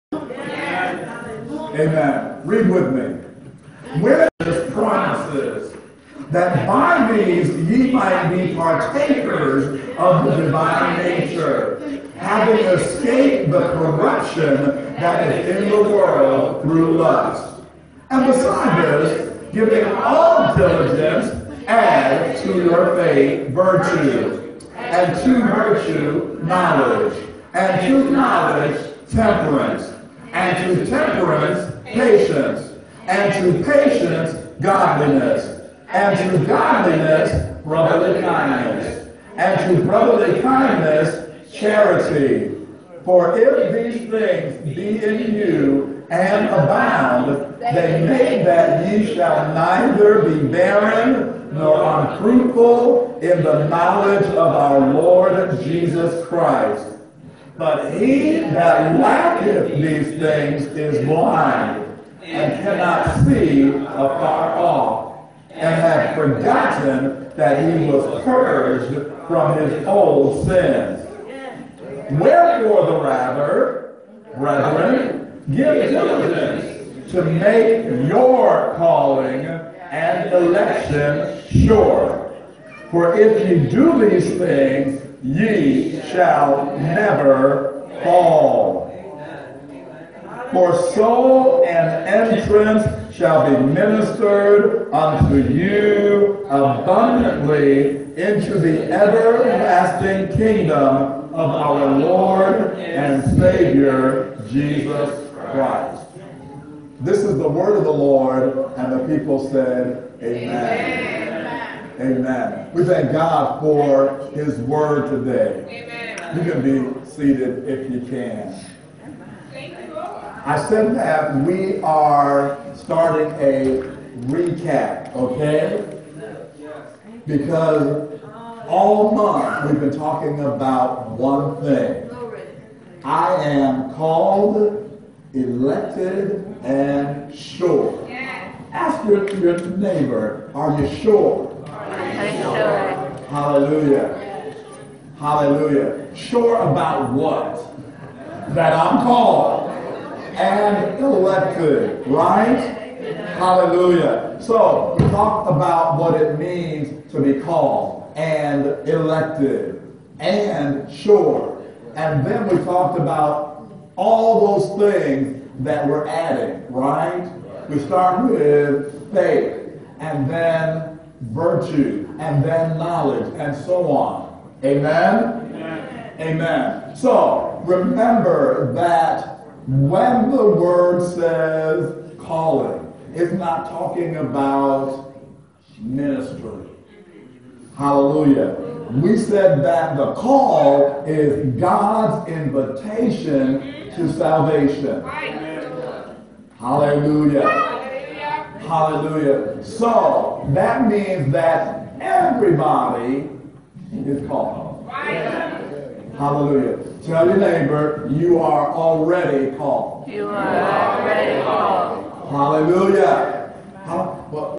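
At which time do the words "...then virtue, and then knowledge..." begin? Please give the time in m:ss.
2:50.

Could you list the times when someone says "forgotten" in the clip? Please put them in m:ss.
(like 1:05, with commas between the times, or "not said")
1:06.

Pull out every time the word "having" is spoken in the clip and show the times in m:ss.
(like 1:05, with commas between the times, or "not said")
0:12.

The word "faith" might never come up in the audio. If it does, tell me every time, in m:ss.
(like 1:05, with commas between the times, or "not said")
0:22, 2:49.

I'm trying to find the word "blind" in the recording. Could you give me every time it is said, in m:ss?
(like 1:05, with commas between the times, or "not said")
1:01.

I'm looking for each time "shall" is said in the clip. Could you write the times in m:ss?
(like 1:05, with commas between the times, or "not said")
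0:49, 1:26, 1:33.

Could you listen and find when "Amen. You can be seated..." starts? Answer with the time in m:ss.
1:55.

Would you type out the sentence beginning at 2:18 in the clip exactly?
Ask your, your neighbor, are you sure?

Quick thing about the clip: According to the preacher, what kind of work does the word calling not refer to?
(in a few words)
ministry.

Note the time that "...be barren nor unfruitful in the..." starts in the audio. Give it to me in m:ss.
0:50.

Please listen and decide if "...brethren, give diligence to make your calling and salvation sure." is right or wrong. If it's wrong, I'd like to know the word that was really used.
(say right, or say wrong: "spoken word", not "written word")
wrong: "election", not "salvation".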